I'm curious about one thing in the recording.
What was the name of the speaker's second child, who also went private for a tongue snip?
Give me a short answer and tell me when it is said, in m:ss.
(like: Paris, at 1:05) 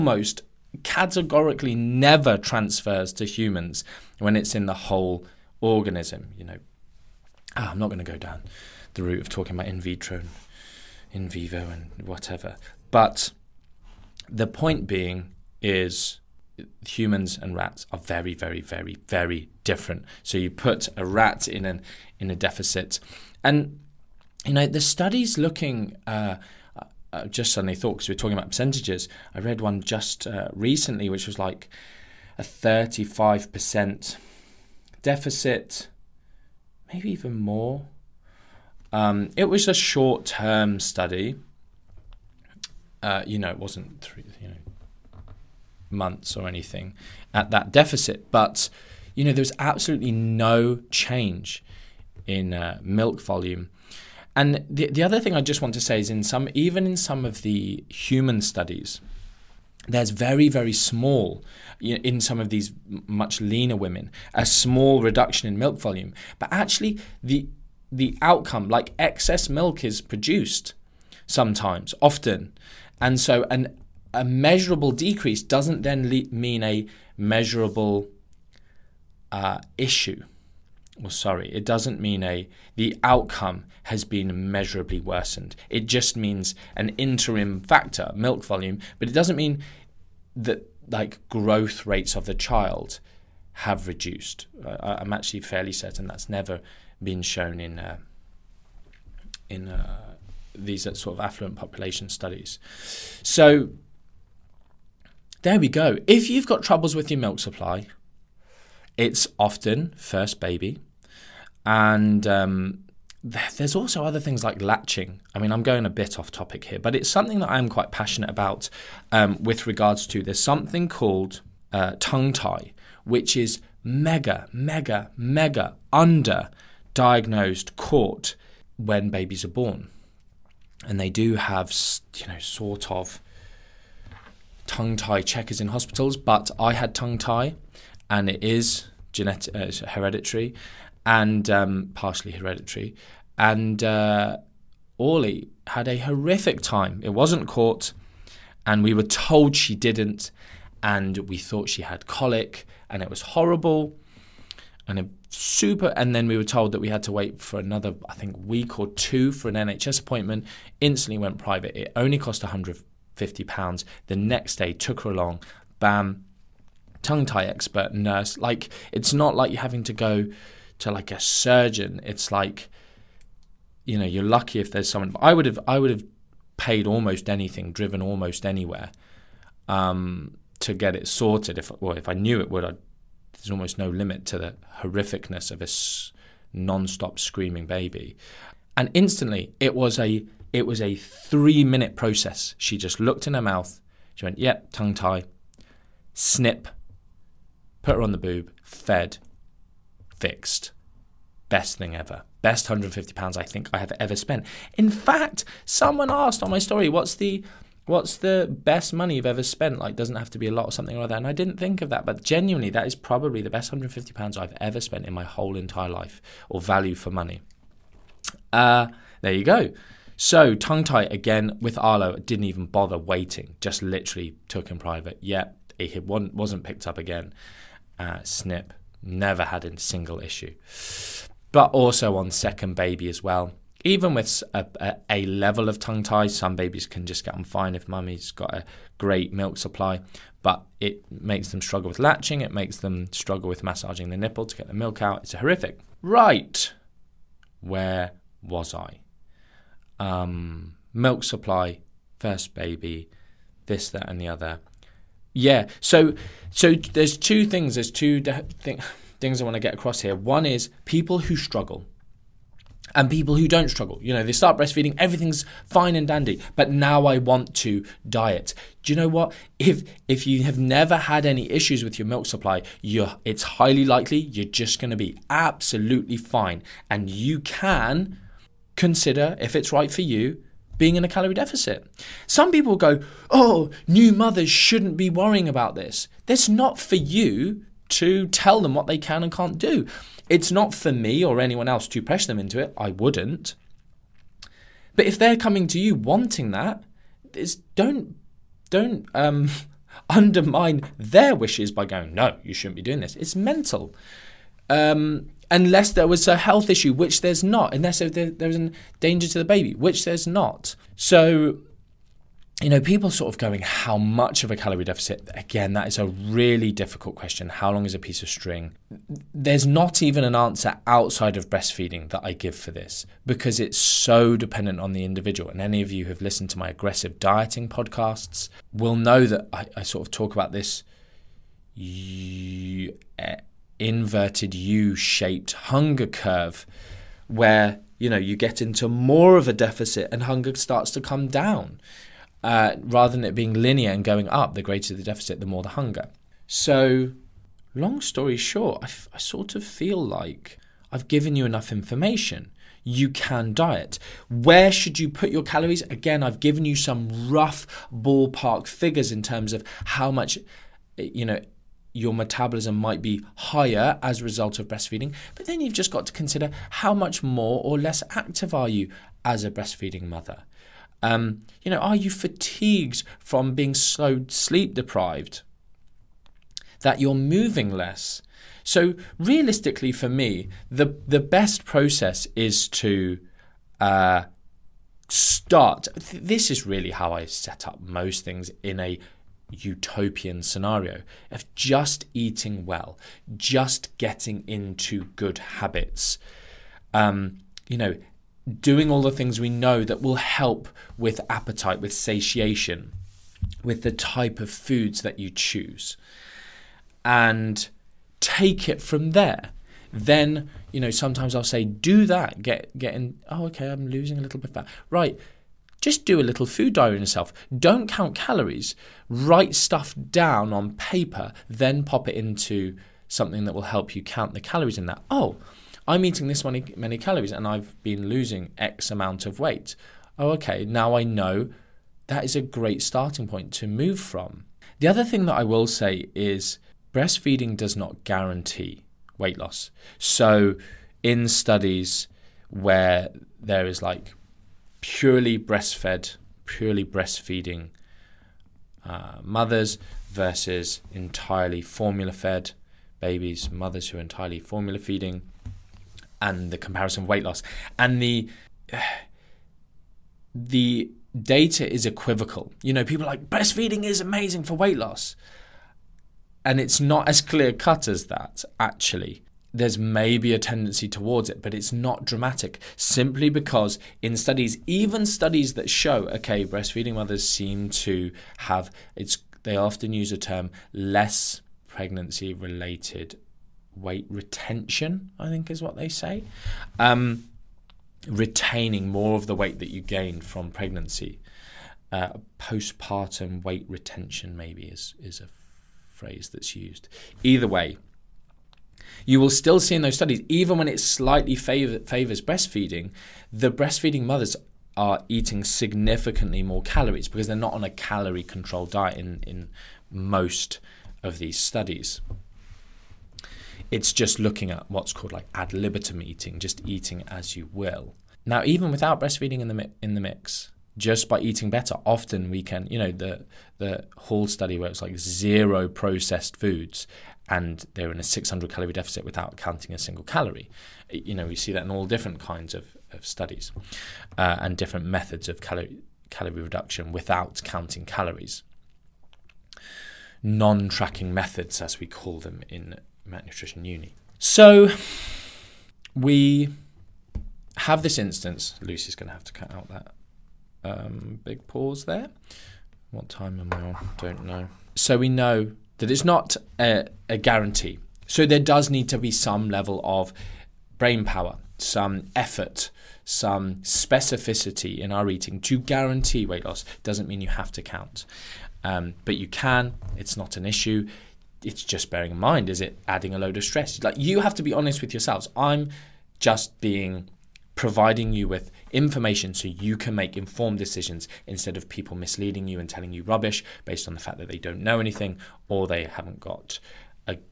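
Arlo, at 3:41.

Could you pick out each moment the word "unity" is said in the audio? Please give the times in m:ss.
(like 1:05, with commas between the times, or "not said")
not said.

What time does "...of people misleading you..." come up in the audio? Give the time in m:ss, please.
9:41.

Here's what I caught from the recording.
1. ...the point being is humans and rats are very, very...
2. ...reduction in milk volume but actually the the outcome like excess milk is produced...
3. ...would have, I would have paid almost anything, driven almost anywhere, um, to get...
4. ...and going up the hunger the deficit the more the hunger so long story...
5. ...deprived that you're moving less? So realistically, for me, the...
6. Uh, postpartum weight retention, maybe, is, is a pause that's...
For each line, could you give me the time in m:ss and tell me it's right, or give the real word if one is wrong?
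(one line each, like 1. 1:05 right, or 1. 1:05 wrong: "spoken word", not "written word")
1. 0:14 right
2. 1:05 right
3. 2:55 right
4. 5:43 wrong: "greater", not "hunger"
5. 6:14 right
6. 8:11 wrong: "phrase", not "pause".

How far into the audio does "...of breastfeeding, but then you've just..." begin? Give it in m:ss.
6:04.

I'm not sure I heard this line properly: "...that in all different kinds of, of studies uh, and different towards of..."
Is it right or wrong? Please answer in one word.
wrong.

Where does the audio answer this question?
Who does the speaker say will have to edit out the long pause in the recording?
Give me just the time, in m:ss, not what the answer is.
9:08.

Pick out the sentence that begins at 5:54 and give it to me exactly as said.
Where should you put your calories?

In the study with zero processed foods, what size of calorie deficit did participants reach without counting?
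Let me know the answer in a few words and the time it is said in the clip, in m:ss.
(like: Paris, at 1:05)
600 calories, at 8:48.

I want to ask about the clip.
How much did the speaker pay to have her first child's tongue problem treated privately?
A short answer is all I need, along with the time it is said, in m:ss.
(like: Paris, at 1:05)
£150, at 2:42.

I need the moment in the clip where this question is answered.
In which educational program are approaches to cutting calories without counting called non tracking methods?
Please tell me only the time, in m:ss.
9:03.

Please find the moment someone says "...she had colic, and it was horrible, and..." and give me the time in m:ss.
2:31.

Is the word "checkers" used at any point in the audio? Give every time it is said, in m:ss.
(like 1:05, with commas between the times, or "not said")
2:15.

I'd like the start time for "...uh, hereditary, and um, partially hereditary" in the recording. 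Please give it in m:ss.
2:19.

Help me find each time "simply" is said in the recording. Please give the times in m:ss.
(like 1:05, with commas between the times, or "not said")
7:52.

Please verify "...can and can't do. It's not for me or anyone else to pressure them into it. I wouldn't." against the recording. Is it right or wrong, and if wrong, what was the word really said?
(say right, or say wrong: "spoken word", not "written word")
right.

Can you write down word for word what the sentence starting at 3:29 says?
Like, doesn't have to be a lot or something like that.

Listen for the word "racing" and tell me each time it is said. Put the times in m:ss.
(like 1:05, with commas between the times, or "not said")
not said.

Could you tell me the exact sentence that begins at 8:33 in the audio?
It's just looking at what's called like ad libitum eating, just eating as you will.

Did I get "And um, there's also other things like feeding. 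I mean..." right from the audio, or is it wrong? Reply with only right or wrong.
wrong.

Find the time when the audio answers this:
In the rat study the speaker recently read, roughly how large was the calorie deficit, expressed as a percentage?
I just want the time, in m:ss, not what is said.
0:32.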